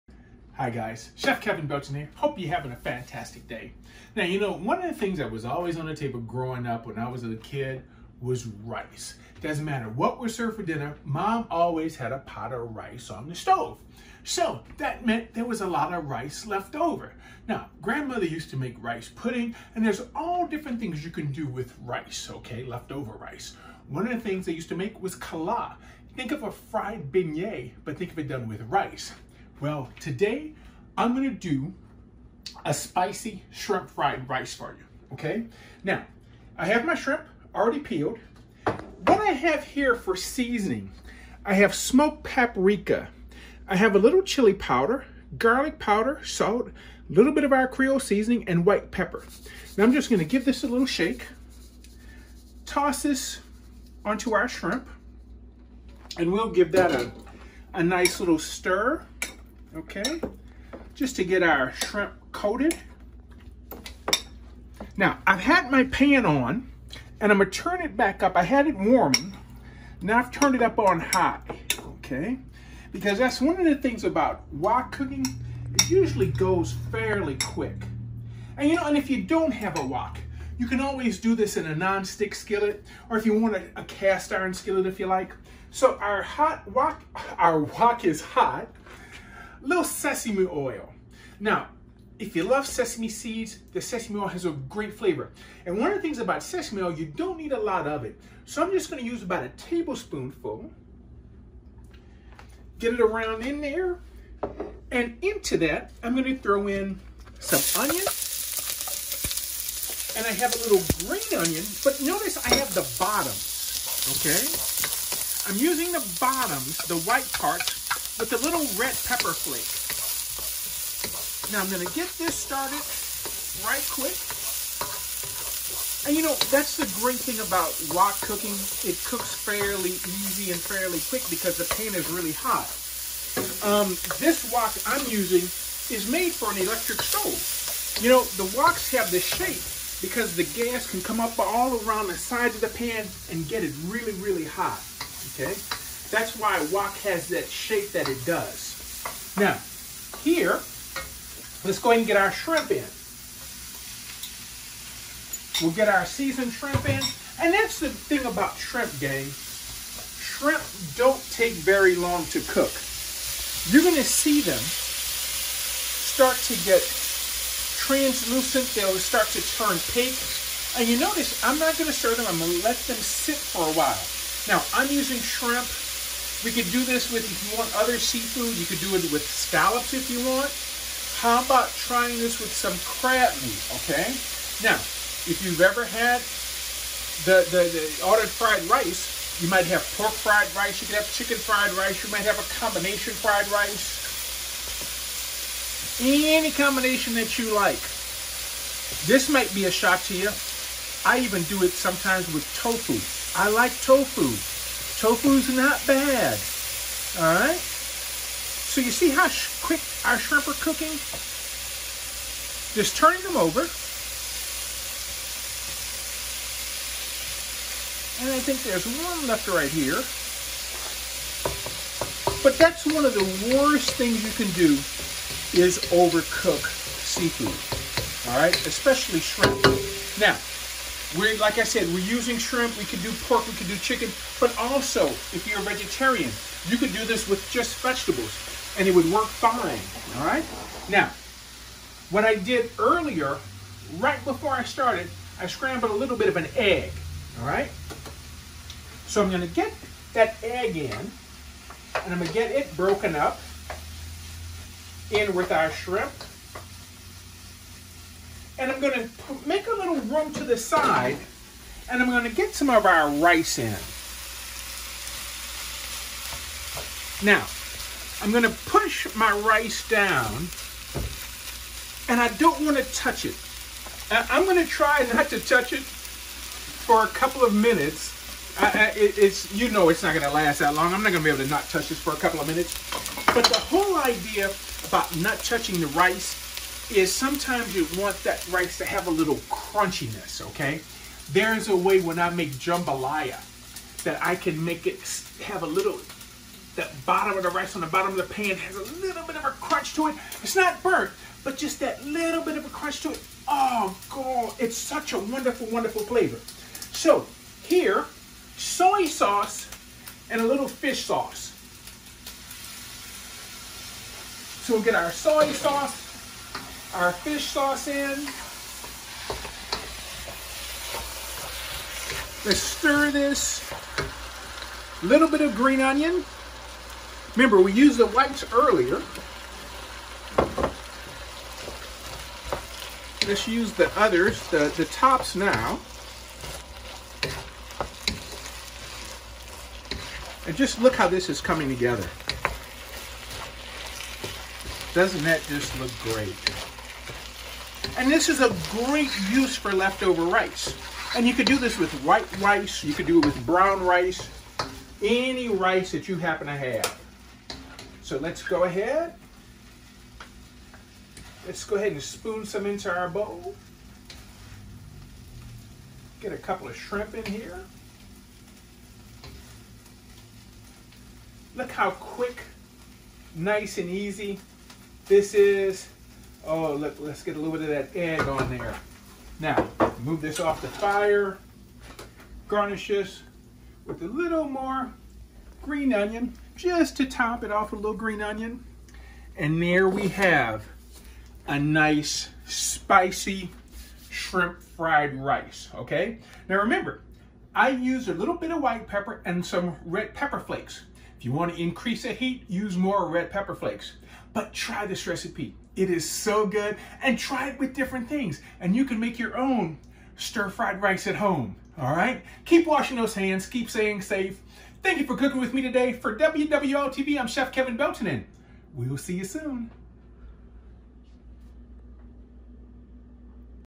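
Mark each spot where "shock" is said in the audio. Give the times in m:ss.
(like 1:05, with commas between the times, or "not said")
3:19.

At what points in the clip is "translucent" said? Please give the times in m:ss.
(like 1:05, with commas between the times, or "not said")
2:47.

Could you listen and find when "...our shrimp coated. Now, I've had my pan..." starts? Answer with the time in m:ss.
1:01.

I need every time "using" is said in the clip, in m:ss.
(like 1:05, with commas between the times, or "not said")
1:55, 2:15, 2:54, 3:51.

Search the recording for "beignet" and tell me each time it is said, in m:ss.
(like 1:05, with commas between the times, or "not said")
0:27.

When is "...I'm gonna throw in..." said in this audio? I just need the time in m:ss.
1:46.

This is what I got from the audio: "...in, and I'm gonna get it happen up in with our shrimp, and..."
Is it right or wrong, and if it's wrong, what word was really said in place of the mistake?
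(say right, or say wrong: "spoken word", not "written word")
wrong: "broken", not "happen".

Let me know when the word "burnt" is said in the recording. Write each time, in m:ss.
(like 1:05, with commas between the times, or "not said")
5:00.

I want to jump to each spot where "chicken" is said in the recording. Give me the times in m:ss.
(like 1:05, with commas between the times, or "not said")
3:11, 3:53.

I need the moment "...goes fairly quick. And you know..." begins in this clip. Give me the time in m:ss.
1:16.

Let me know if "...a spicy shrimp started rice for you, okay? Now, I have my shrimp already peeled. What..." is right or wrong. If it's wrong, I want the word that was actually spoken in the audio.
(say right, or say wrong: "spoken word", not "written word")
wrong: "fried", not "started".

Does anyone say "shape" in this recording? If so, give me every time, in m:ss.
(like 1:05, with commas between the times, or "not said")
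2:19, 2:27.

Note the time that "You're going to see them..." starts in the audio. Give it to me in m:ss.
2:43.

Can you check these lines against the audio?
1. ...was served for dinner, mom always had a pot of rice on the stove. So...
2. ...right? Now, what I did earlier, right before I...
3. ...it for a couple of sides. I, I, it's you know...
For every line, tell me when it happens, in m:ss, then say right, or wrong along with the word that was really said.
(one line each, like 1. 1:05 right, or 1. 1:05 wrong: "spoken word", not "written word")
1. 0:10 right
2. 4:00 right
3. 4:35 wrong: "minutes", not "sides".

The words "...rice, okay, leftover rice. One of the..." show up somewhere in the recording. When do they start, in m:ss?
0:21.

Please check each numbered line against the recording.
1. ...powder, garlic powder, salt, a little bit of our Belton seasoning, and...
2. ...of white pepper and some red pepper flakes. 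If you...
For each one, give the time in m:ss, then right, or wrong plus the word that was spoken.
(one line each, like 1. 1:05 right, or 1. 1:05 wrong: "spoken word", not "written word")
1. 0:44 wrong: "Creole", not "Belton"
2. 6:38 right.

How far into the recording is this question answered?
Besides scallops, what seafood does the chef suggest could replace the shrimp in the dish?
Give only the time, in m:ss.
3:02.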